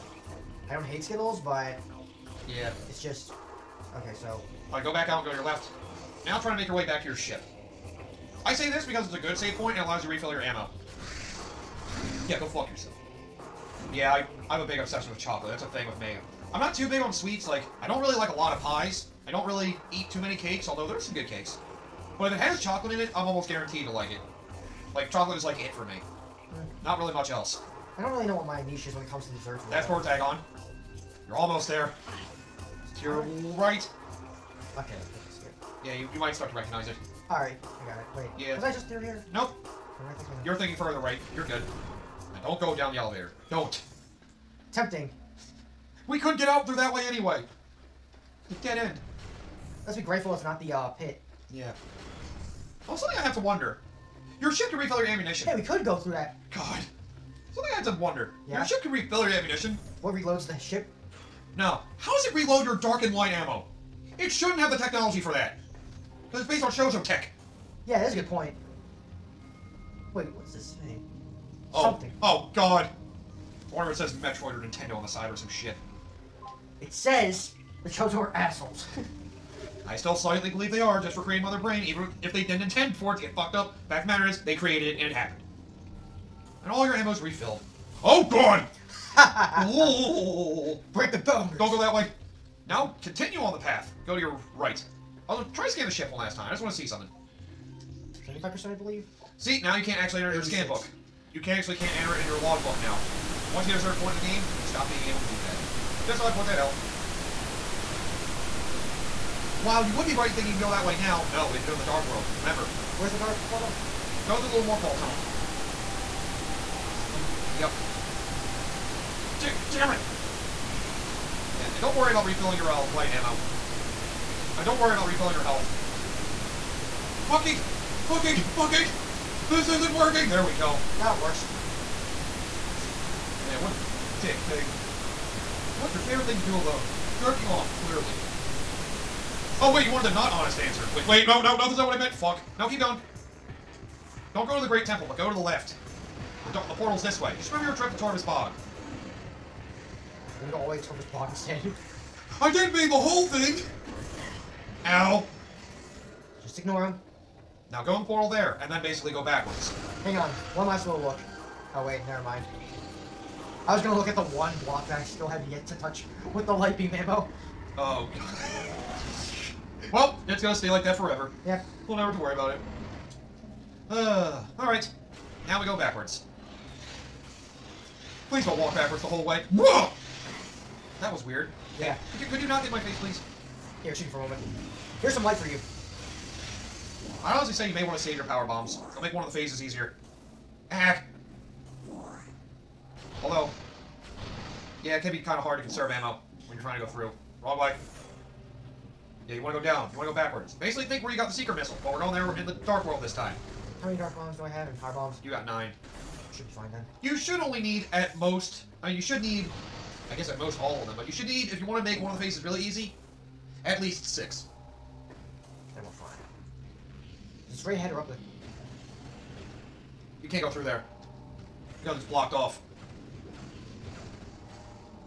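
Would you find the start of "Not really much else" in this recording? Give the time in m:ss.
0:26.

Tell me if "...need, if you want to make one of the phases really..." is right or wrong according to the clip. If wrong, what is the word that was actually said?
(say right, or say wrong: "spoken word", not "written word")
right.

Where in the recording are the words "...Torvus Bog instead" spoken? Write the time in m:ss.
2:30.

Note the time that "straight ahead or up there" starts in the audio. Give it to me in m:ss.
3:37.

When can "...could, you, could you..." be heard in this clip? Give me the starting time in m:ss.
3:02.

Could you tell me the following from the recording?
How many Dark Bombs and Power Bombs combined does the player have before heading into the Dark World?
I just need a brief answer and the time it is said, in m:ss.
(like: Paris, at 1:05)
9, at 3:25.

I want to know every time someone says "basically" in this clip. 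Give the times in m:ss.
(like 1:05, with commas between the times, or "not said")
2:38, 3:20.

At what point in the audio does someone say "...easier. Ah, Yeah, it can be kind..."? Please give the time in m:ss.
3:09.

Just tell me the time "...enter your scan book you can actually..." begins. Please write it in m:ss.
1:40.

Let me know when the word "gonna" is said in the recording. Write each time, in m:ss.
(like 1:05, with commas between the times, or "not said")
2:43, 2:50.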